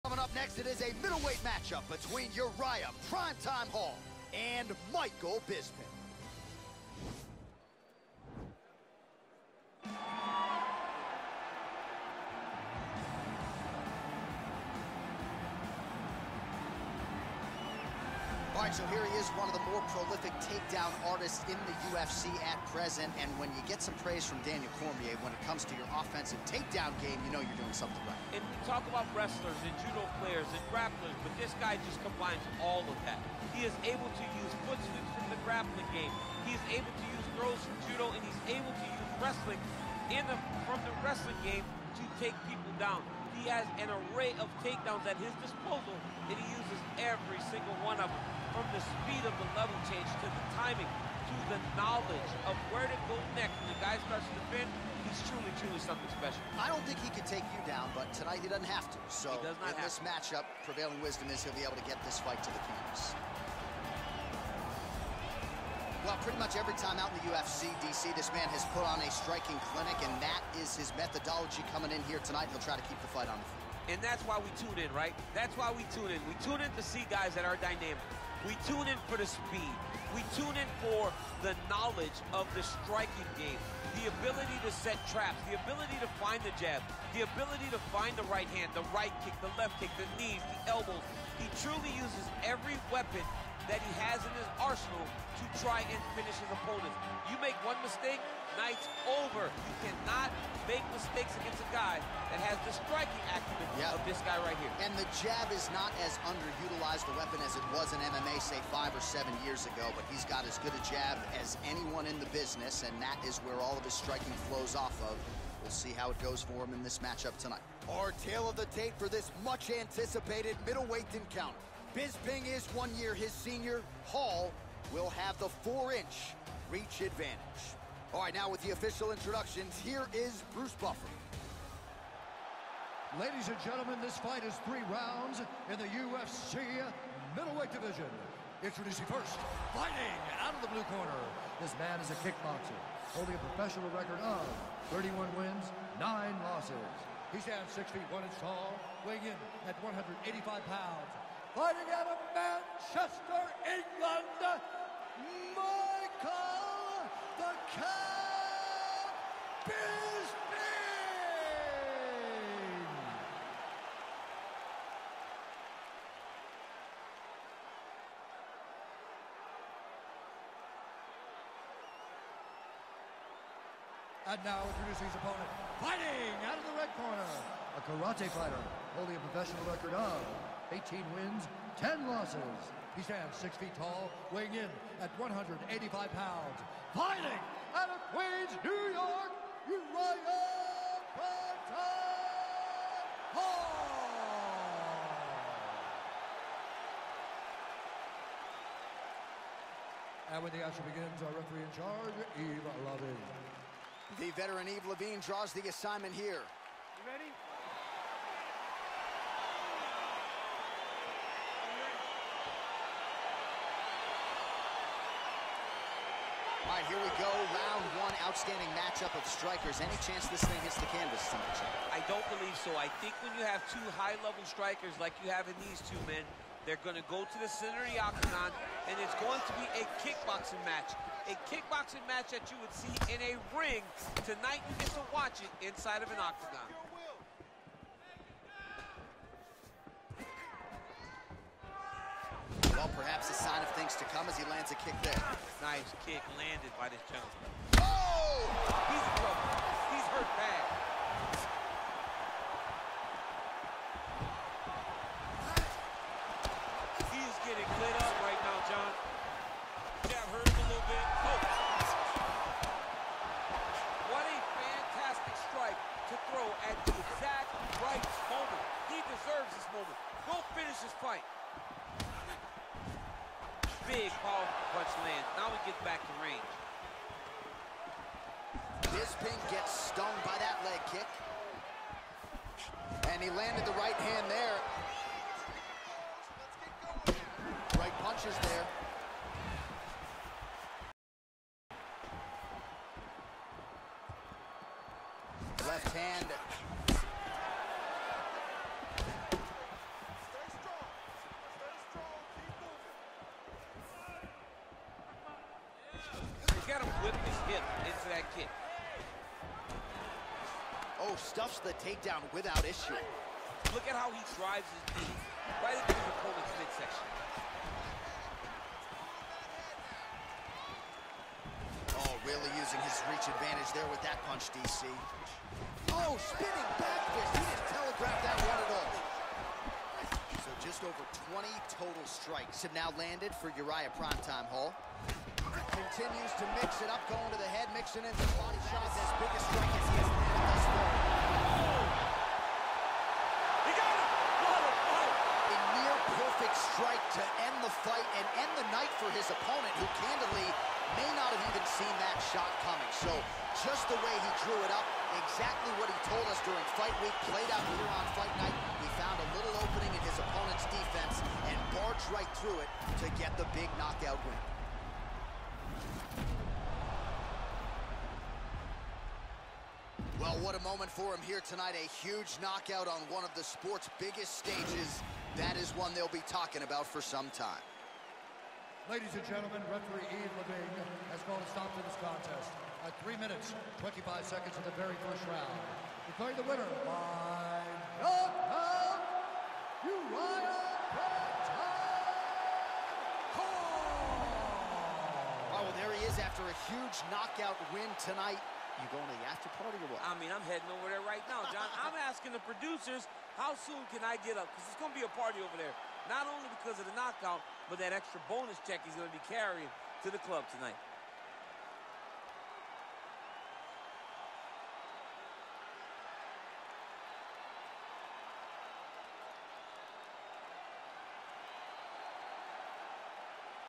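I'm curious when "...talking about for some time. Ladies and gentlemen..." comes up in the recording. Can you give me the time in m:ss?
6:16.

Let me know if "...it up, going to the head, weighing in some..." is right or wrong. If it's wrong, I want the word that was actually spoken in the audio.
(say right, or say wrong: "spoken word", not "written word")
wrong: "mixing", not "weighing".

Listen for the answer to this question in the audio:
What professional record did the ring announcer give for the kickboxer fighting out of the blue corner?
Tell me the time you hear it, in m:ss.
2:24.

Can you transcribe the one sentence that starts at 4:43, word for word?
And he landed the right hand there.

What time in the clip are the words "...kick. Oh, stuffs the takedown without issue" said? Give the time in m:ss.
5:08.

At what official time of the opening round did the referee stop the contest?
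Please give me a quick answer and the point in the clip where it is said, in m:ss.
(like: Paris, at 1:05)
3:25, at 6:23.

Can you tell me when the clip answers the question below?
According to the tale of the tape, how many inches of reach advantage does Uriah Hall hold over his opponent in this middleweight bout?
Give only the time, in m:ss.
2:05.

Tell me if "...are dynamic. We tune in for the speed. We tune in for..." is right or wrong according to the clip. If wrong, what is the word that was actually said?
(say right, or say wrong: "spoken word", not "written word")
right.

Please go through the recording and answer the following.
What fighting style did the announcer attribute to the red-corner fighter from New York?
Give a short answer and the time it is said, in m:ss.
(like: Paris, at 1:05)
karate, at 2:57.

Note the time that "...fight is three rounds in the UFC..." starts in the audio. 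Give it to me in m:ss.
2:14.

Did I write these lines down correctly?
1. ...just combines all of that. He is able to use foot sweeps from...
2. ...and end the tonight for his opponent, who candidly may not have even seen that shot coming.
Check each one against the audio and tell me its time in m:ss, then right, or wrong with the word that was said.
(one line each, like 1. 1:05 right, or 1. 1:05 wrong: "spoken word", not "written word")
1. 0:31 right
2. 5:48 wrong: "night", not "tonight".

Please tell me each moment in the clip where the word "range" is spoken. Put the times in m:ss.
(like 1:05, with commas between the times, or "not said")
4:36.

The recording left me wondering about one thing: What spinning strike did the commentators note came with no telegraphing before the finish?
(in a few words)
spinning back fist.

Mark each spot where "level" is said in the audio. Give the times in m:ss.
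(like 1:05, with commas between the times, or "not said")
0:49, 3:43.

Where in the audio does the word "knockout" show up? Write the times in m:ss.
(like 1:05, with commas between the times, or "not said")
6:03, 6:12, 6:28, 6:37, 6:46.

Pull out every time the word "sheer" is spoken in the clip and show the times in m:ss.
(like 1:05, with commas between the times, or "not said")
not said.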